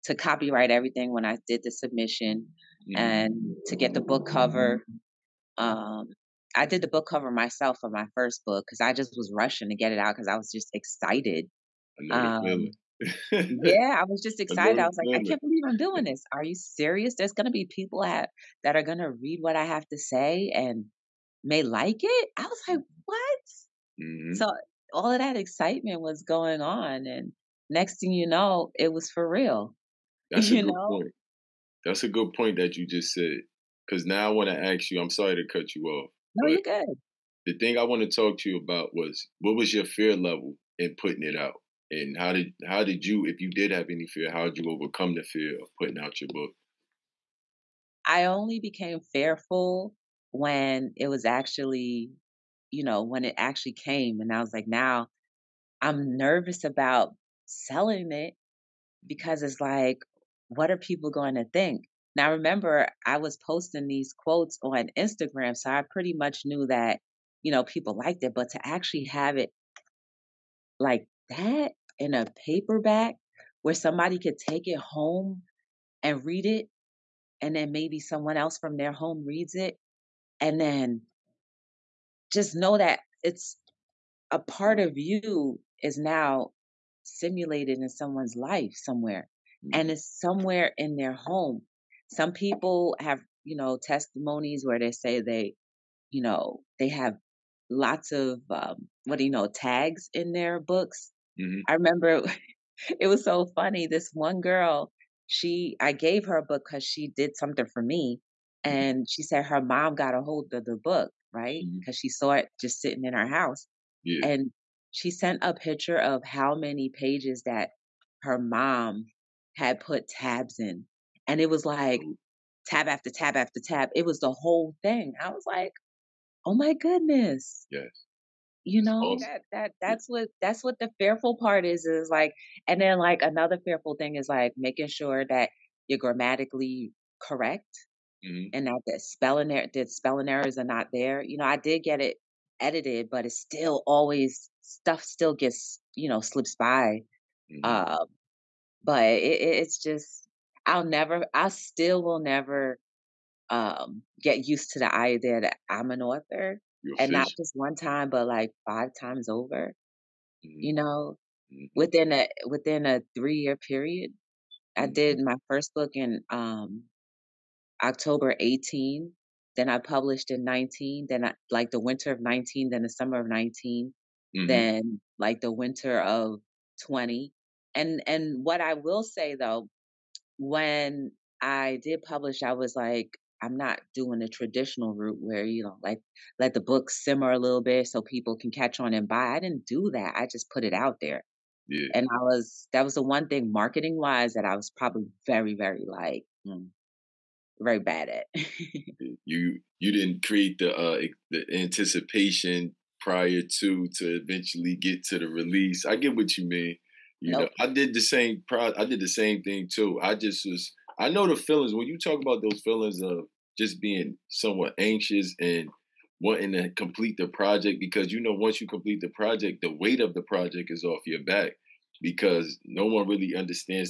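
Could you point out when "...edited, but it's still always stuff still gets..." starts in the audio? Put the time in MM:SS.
02:22.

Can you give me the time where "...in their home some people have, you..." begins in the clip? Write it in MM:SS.
01:30.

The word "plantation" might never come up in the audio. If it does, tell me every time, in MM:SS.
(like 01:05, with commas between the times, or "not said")
not said.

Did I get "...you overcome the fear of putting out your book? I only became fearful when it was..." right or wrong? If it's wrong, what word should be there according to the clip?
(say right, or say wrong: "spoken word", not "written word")
right.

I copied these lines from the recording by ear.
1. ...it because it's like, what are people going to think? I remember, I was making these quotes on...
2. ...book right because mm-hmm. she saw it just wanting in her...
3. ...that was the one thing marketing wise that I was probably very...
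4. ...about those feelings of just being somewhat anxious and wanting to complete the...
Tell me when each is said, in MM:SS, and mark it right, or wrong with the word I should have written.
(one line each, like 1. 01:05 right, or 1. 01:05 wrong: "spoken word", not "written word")
1. 00:58 wrong: "posting", not "making"
2. 01:50 wrong: "sitting", not "wanting"
3. 03:12 right
4. 03:32 right.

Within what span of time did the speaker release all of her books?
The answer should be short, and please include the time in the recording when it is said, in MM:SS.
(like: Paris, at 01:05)
3 years, at 02:43.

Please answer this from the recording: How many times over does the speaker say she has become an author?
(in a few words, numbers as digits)
5.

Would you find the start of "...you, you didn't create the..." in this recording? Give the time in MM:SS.
03:19.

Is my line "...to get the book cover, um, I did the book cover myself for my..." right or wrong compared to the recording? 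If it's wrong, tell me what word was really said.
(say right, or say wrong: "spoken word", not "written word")
right.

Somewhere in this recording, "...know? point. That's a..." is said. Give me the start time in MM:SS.
00:30.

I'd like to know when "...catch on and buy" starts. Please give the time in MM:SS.
03:08.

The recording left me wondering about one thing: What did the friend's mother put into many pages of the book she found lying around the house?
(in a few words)
tabs.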